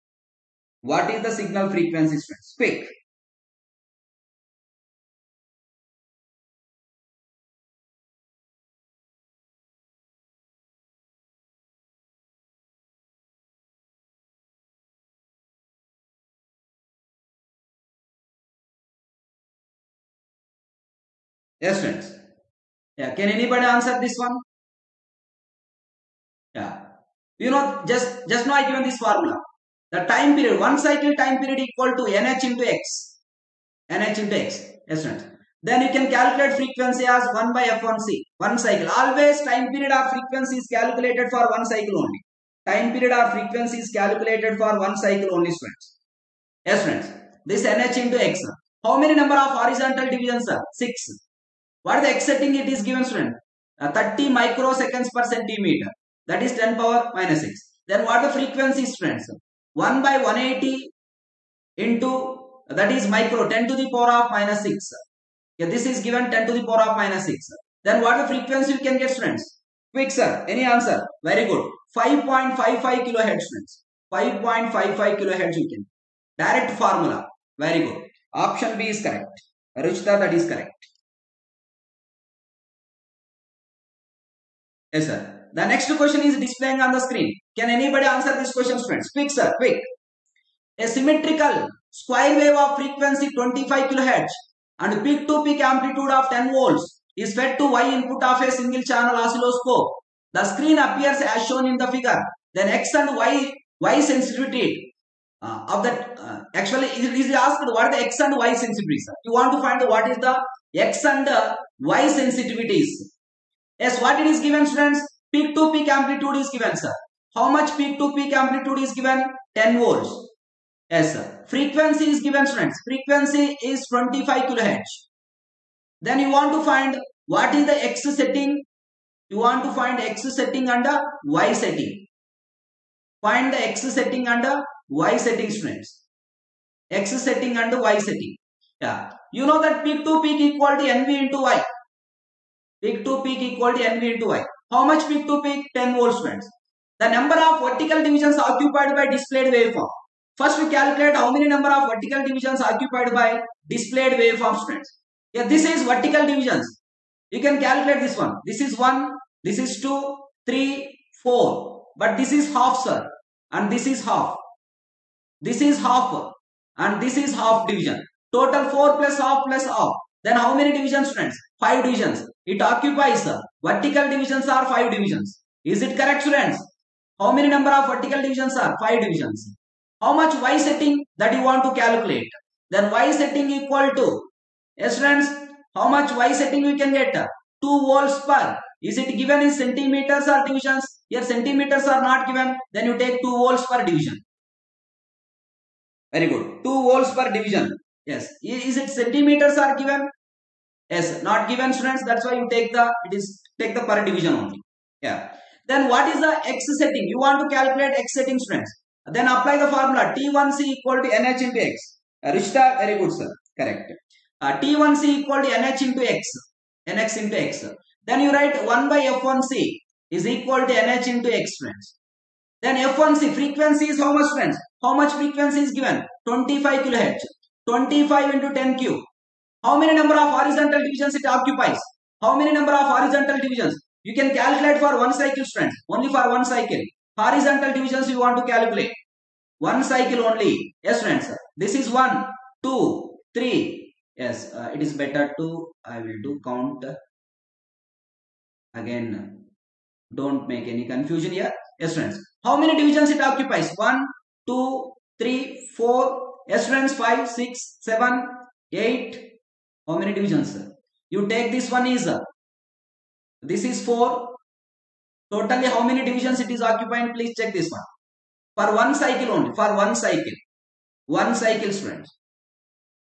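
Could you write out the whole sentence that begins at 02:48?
Total 4 plus half plus half.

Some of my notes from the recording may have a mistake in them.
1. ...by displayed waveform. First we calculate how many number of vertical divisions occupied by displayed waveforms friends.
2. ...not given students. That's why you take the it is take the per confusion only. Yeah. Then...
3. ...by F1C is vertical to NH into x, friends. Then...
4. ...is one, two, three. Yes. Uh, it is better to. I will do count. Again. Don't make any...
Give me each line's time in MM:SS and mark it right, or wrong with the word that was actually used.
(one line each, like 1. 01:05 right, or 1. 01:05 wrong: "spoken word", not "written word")
1. 02:28 right
2. 03:21 wrong: "division", not "confusion"
3. 03:38 wrong: "equal", not "vertical"
4. 04:01 right.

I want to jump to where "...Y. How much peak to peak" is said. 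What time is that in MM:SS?
02:24.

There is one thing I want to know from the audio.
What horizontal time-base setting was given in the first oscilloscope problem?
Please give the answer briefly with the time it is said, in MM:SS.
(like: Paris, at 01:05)
30 microseconds per centimeter, at 00:53.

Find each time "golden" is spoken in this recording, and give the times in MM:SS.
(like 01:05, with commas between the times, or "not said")
not said.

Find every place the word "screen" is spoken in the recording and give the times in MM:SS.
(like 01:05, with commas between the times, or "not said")
01:26, 01:40.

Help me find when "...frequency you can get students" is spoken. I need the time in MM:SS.
01:08.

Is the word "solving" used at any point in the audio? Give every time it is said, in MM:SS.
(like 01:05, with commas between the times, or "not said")
not said.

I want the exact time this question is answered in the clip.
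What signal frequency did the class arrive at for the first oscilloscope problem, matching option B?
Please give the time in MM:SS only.
01:14.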